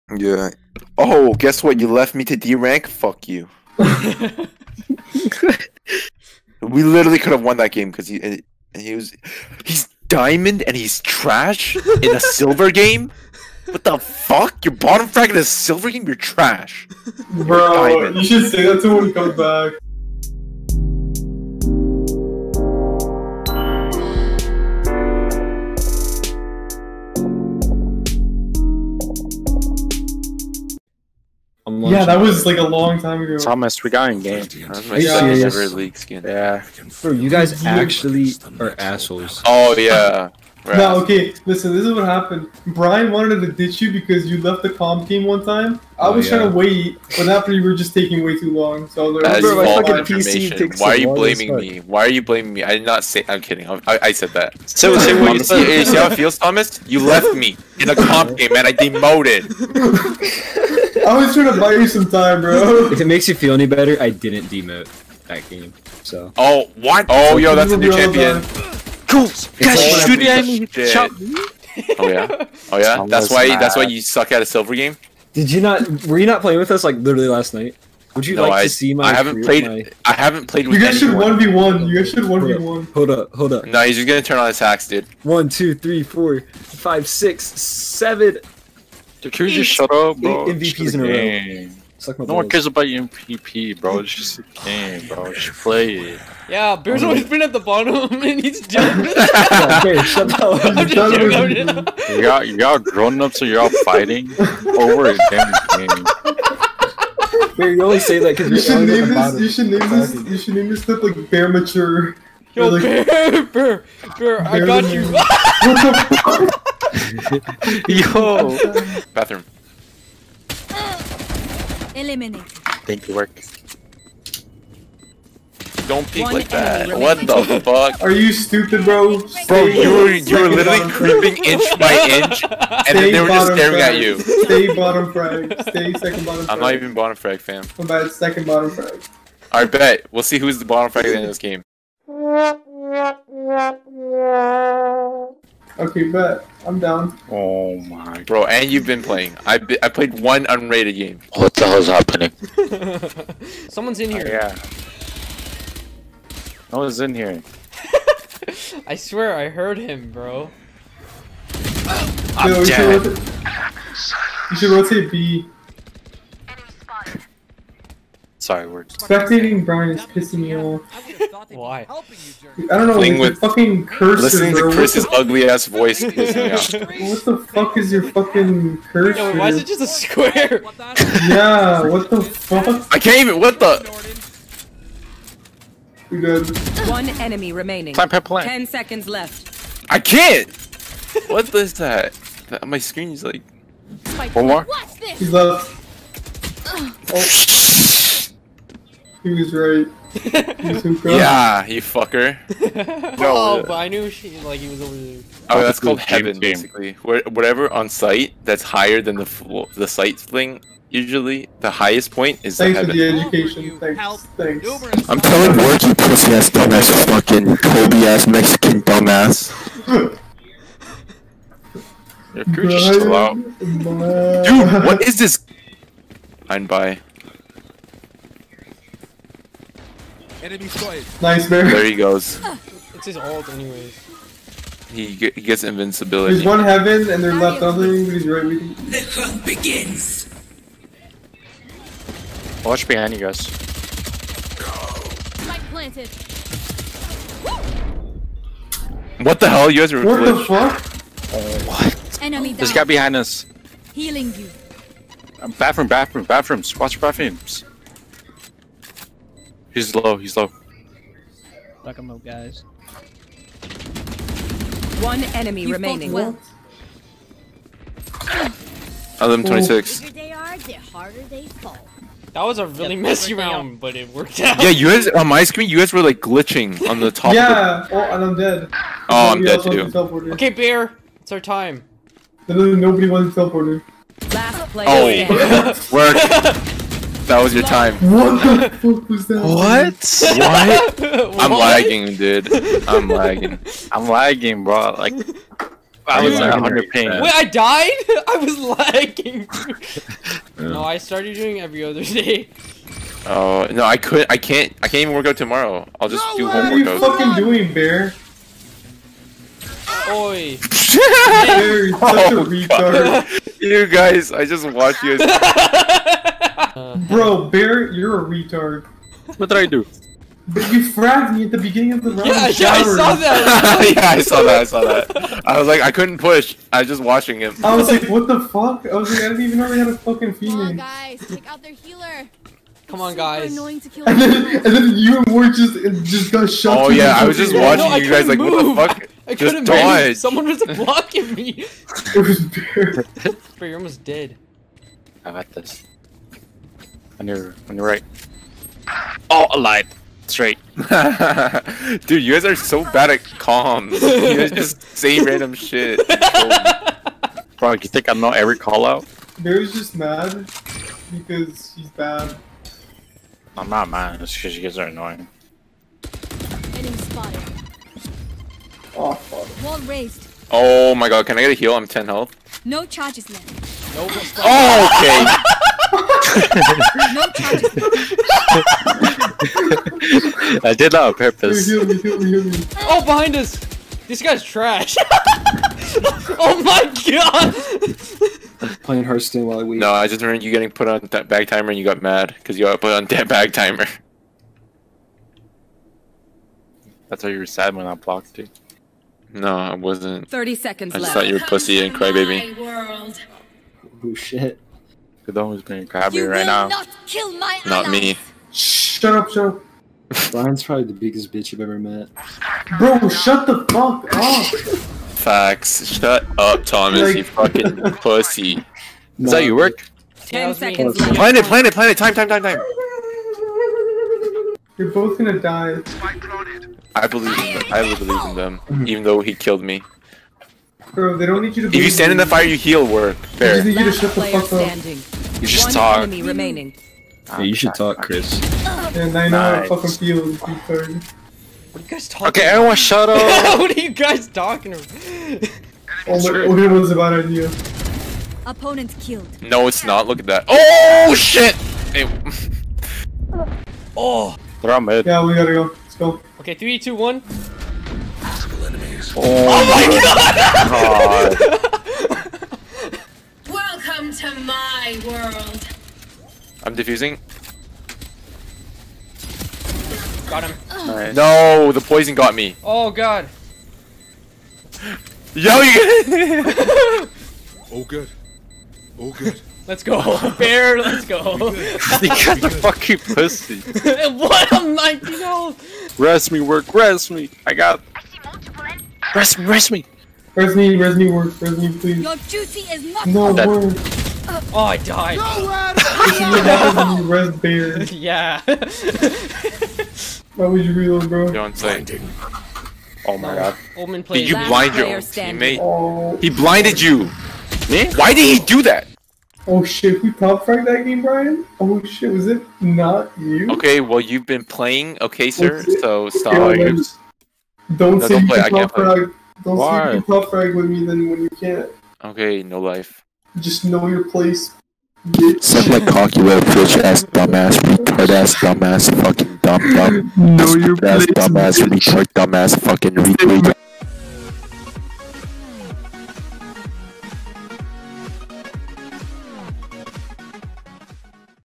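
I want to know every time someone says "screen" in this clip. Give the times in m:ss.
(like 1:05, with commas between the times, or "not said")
3:12, 4:35.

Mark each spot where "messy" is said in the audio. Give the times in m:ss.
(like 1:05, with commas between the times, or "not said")
4:33.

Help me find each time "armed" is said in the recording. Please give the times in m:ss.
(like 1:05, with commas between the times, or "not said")
not said.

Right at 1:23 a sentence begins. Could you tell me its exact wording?
No, he's just gonna turn on his hacks, dude.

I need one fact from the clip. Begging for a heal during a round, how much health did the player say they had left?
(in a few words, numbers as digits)
10.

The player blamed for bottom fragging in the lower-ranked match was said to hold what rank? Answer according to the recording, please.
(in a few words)
Diamond.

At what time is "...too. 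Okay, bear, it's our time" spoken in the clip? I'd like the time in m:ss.
4:39.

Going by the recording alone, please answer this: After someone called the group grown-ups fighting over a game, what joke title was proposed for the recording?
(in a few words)
Bear Mature.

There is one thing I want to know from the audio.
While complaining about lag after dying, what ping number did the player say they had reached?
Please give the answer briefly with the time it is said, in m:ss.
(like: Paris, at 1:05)
100, at 4:56.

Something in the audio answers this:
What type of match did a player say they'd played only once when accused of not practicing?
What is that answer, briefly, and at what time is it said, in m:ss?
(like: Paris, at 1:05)
Unrated, at 2:30.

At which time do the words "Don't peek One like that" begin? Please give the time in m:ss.
2:05.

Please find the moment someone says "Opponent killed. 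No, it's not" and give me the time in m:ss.
7:28.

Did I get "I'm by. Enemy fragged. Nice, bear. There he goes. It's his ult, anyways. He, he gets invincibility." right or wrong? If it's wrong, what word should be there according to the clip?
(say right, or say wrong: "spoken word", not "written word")
wrong: "spotted", not "fragged".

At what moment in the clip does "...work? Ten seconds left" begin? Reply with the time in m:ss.
6:59.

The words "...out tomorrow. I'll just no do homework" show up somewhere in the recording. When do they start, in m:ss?
5:05.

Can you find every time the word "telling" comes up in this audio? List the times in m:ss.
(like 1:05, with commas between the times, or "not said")
3:35.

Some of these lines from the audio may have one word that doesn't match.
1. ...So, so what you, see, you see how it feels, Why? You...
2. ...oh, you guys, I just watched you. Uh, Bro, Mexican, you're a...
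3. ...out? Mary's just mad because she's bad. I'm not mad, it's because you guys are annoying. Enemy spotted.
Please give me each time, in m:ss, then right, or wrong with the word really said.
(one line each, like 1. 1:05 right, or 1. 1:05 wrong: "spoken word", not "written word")
1. 0:54 wrong: "Thomas", not "Why"
2. 5:12 wrong: "Bear", not "Mexican"
3. 5:58 right.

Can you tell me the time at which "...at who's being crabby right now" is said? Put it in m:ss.
6:45.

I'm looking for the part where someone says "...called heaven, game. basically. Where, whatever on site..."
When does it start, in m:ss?
3:25.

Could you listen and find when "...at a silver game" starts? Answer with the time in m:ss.
1:14.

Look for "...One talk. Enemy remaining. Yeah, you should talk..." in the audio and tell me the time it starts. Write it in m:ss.
7:15.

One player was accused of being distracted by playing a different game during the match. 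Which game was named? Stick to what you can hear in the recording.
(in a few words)
Hearthstone.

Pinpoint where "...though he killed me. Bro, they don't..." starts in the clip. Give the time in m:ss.
7:09.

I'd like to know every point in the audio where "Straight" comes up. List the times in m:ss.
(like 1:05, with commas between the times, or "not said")
5:50.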